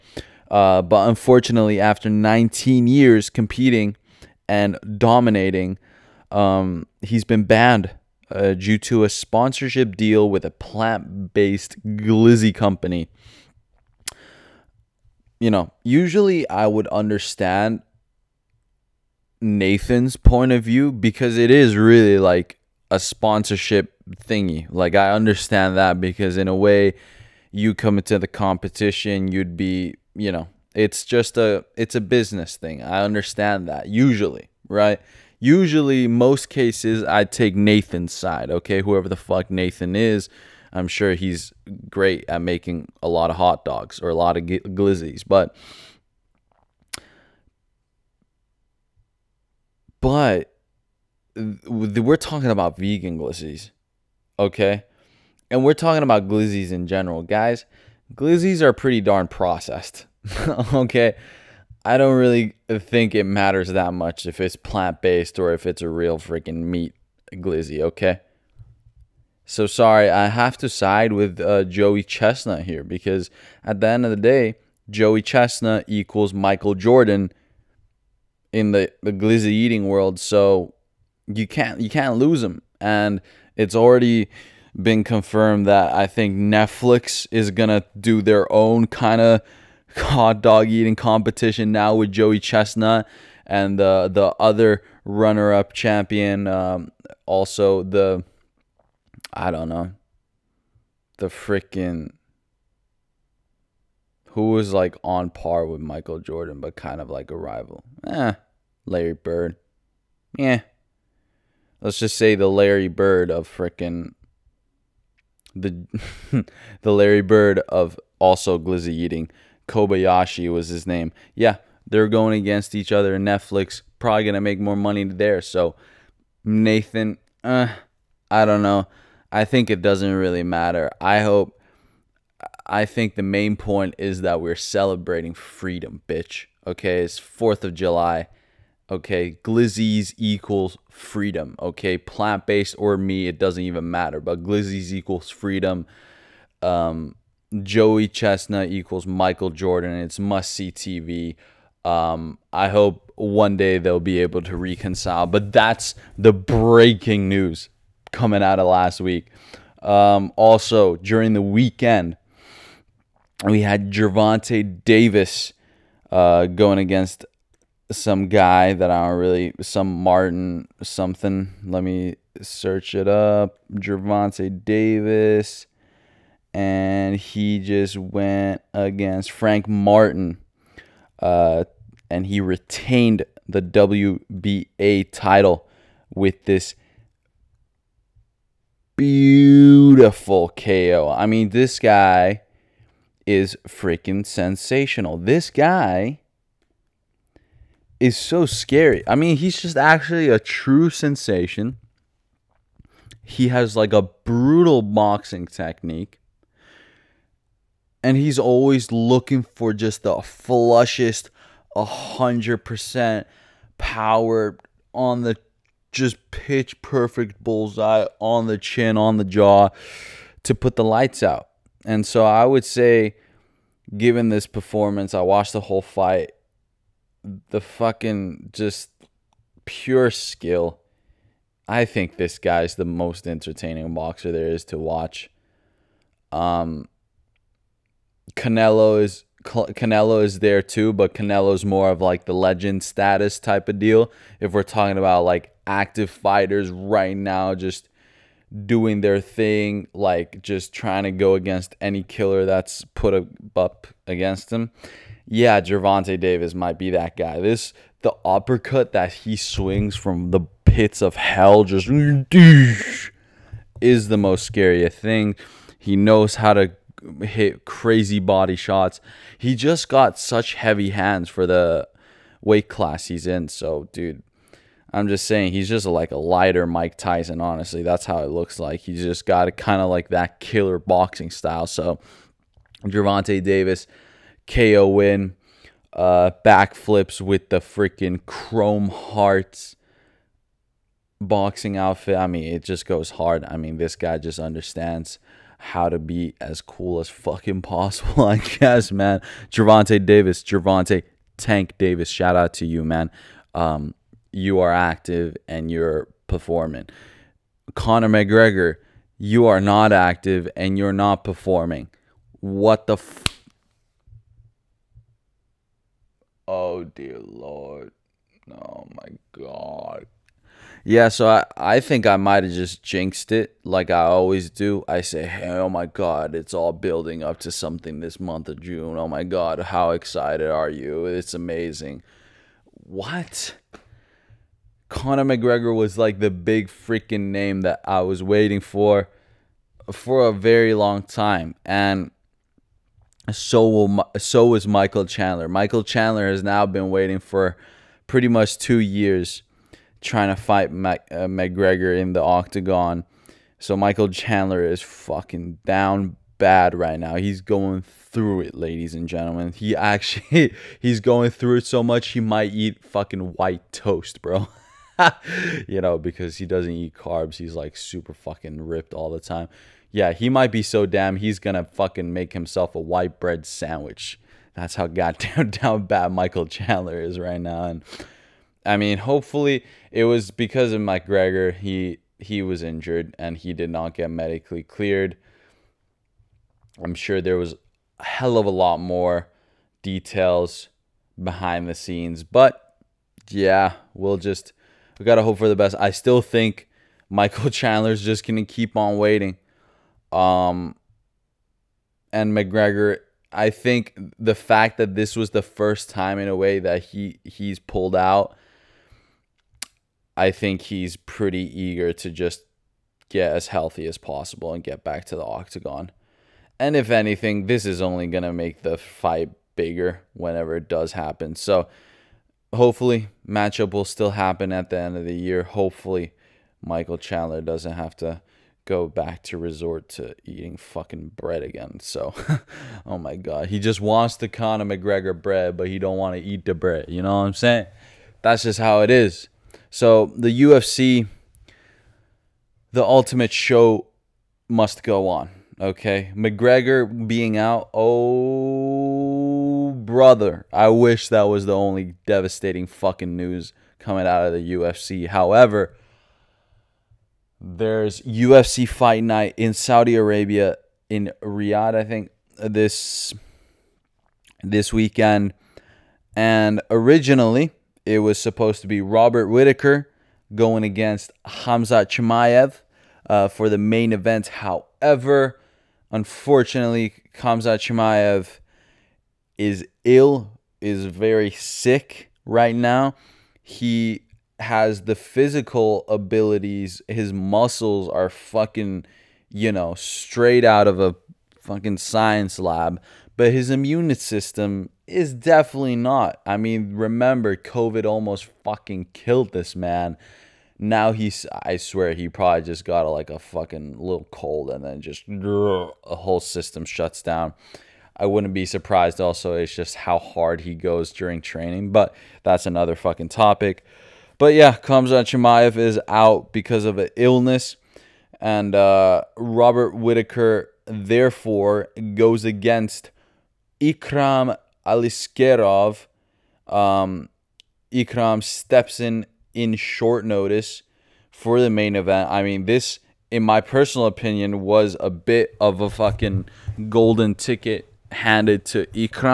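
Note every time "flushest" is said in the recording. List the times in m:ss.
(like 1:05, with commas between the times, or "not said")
3:30.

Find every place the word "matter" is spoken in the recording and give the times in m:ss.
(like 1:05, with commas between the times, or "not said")
1:03, 2:10, 2:23.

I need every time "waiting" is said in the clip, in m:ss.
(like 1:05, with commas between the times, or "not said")
5:38, 5:46, 6:38.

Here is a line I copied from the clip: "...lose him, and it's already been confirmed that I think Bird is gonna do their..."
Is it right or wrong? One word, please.
wrong.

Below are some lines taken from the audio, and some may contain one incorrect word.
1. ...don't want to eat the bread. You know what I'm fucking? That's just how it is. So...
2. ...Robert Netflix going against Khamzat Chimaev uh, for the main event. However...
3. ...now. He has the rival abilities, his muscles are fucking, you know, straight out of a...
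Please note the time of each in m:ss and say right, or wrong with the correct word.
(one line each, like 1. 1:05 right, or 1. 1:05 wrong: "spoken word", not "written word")
1. 7:15 wrong: "saying", not "fucking"
2. 7:48 wrong: "Whittaker", not "Netflix"
3. 8:02 wrong: "physical", not "rival".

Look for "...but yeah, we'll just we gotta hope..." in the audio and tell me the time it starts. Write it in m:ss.
6:32.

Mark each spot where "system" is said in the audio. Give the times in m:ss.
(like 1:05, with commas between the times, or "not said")
8:13, 8:26.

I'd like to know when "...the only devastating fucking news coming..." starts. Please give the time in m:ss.
7:31.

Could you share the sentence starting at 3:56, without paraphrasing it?
Um, Canelo is Canelo is there too, but Canelo's more of like the legend status type of deal.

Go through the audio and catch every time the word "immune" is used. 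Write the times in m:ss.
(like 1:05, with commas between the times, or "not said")
8:13.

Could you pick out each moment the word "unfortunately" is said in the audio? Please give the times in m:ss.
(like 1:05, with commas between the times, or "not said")
0:01, 7:55.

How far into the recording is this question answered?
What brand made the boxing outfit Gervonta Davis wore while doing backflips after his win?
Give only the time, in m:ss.
4:48.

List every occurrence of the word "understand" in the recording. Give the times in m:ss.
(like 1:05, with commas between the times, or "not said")
0:16, 0:25, 0:33, 4:54.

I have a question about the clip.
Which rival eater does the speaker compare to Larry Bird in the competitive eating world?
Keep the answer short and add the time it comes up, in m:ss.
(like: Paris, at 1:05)
Kobayashi, at 1:59.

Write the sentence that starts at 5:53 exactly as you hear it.
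So Michael Chandler is fucking down bad right now.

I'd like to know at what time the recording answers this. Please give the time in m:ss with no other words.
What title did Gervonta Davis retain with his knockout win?
3:03.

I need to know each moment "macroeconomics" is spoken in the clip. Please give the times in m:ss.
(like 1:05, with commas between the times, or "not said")
not said.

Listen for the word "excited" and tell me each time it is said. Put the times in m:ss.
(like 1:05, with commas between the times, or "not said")
5:29.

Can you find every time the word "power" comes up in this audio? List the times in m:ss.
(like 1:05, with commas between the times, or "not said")
3:33.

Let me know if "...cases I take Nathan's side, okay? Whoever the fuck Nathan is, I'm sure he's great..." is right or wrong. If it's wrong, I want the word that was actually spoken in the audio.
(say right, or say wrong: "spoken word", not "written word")
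right.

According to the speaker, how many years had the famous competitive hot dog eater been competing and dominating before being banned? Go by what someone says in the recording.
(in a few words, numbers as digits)
19.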